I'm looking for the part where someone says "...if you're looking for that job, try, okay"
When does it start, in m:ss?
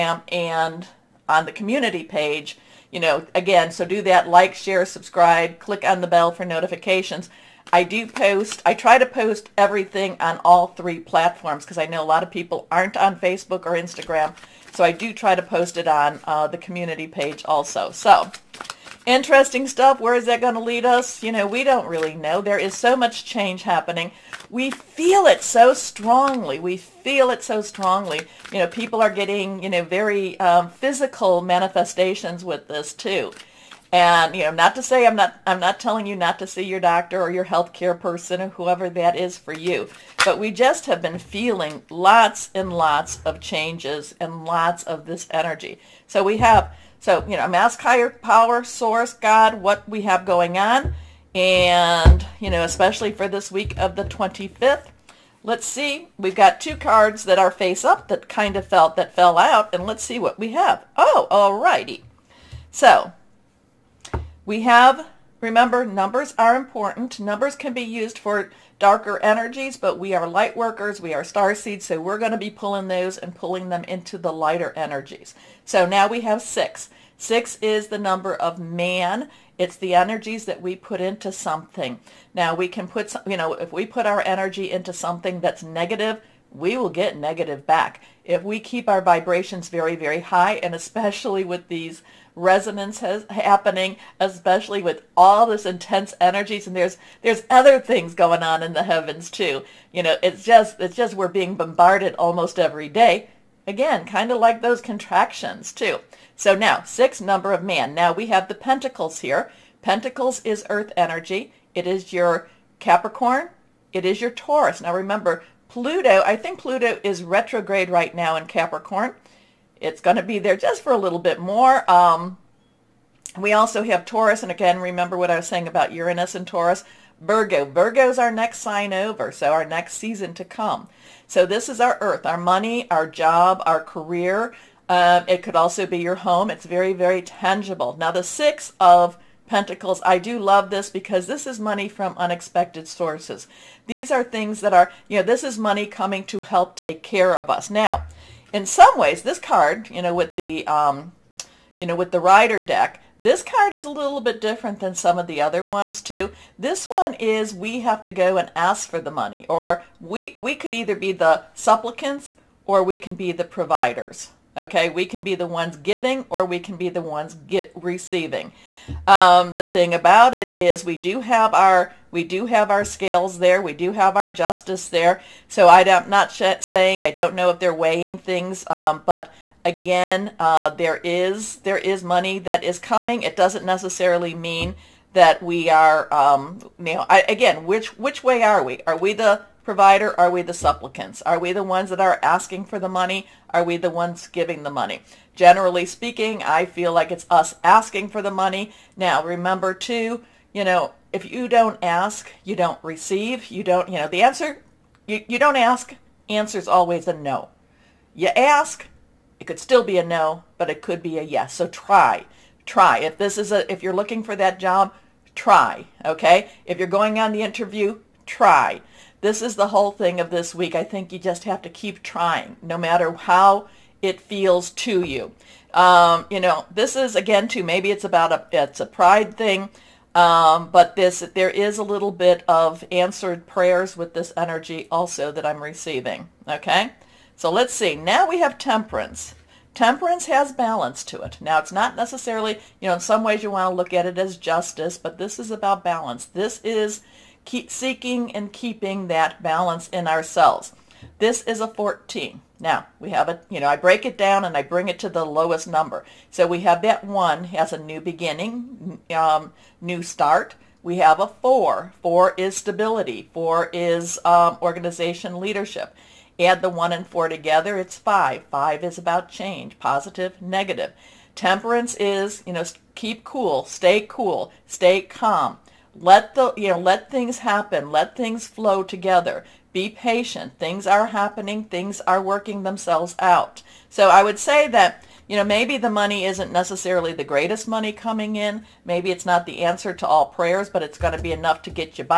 3:33.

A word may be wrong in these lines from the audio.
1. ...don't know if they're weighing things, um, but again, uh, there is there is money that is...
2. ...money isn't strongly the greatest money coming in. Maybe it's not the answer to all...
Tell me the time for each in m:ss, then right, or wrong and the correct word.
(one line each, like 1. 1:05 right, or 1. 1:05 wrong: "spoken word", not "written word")
1. 2:57 right
2. 4:45 wrong: "necessarily", not "strongly".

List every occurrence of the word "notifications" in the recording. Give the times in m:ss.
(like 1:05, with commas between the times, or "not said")
0:06.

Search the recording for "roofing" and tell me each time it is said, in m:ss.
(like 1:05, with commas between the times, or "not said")
not said.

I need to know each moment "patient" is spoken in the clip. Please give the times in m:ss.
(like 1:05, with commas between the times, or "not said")
4:39.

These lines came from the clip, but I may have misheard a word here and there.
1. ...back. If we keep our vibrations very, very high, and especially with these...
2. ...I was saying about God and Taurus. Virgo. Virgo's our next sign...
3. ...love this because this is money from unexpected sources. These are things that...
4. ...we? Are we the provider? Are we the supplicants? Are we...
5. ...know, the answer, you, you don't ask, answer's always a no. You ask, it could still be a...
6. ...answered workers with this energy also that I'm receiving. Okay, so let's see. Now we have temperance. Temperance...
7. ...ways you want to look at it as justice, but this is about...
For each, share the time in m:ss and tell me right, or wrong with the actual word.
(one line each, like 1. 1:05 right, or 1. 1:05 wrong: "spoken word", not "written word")
1. 1:27 right
2. 2:05 wrong: "Uranus", not "God"
3. 2:20 right
4. 3:08 right
5. 3:23 right
6. 3:52 wrong: "prayers", not "workers"
7. 4:03 right.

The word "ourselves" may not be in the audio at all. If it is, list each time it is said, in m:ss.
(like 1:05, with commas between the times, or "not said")
4:10.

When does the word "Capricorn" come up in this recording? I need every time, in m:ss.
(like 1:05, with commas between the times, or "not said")
1:52, 1:58.